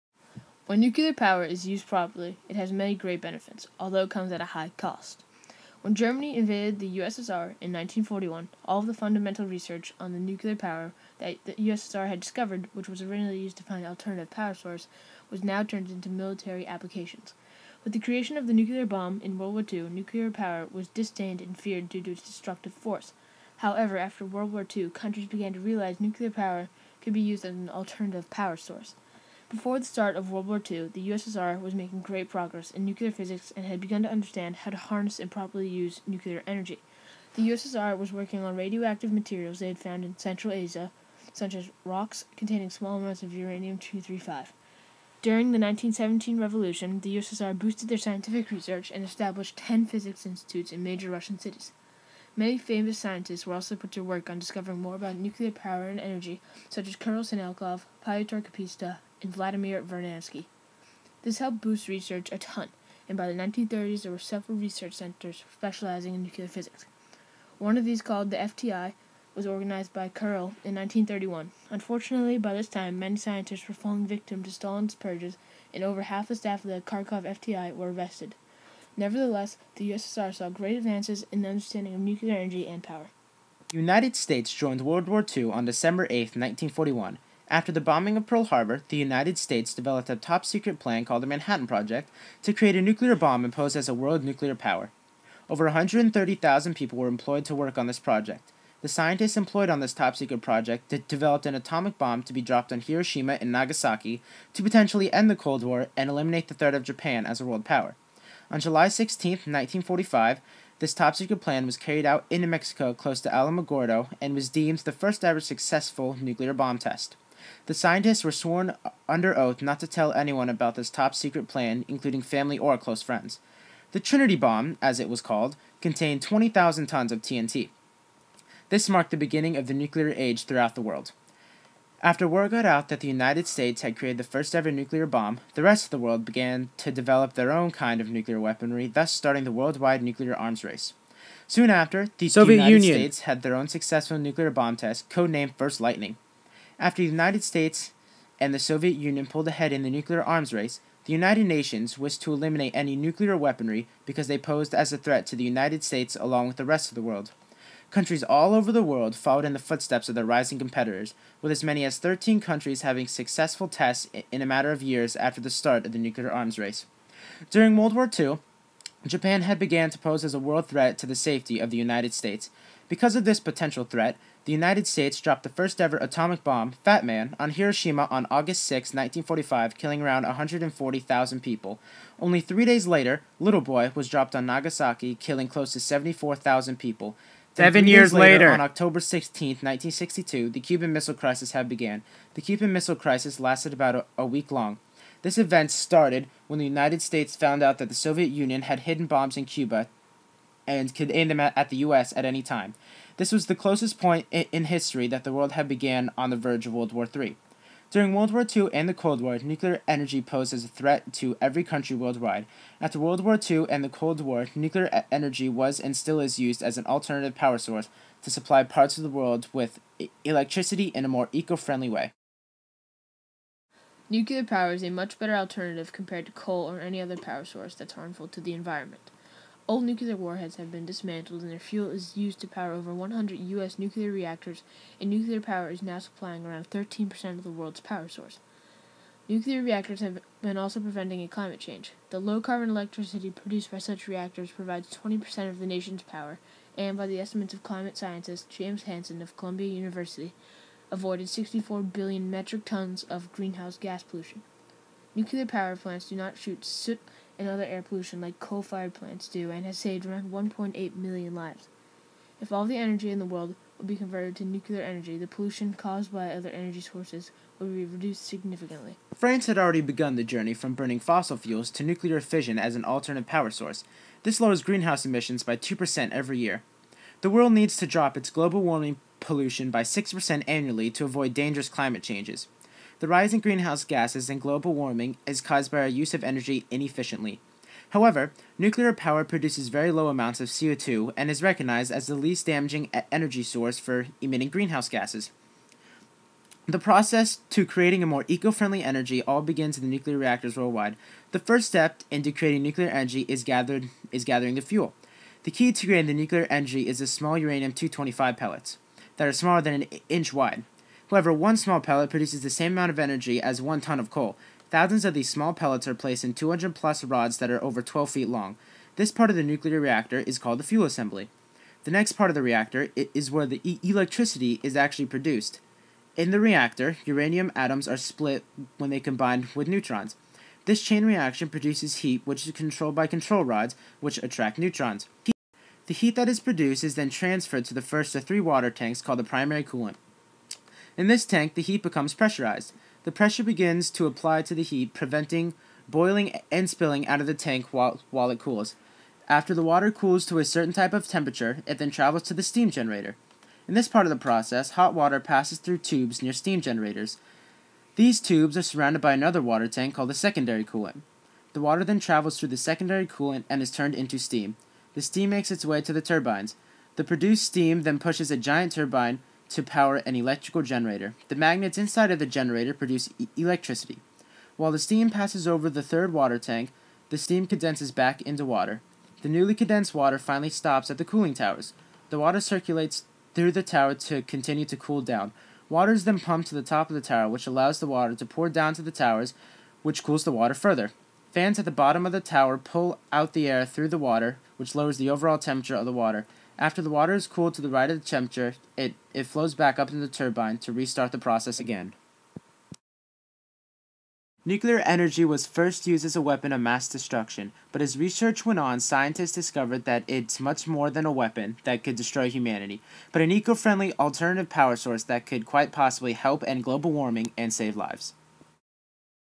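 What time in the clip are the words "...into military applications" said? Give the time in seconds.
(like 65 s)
15 s.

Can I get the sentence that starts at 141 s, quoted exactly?
Soon after, the Soviet United Union.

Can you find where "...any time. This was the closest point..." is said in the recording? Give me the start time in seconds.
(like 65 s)
202 s.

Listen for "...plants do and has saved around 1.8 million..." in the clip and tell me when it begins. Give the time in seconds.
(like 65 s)
258 s.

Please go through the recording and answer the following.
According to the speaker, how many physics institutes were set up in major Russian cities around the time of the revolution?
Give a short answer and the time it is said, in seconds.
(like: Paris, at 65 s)
10, at 49 s.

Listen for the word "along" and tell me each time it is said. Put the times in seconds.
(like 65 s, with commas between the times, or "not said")
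156 s.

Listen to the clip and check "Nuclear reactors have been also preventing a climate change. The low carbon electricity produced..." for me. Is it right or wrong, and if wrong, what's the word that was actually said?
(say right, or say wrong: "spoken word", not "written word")
right.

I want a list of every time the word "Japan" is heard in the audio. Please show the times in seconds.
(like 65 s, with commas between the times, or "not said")
106 s, 169 s.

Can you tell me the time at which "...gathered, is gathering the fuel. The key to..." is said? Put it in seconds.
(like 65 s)
303 s.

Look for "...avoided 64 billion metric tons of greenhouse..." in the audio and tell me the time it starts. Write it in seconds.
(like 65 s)
250 s.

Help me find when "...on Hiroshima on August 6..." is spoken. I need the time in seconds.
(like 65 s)
177 s.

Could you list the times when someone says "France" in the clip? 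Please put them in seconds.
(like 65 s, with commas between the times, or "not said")
269 s.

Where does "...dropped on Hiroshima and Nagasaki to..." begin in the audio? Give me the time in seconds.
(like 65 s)
102 s.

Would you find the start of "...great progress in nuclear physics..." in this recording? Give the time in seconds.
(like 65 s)
31 s.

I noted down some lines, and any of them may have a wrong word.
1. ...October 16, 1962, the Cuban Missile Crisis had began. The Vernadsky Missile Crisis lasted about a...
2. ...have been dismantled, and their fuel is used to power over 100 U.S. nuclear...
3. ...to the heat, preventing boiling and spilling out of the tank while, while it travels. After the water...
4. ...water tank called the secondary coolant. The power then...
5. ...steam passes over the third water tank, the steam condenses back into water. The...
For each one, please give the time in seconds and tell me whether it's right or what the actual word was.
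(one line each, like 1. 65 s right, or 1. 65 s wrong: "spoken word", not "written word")
1. 188 s wrong: "Cuban", not "Vernadsky"
2. 230 s right
3. 344 s wrong: "cools", not "travels"
4. 359 s wrong: "water", not "power"
5. 374 s right.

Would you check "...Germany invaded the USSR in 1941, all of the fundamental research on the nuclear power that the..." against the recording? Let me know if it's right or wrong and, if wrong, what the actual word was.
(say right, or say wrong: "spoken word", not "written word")
right.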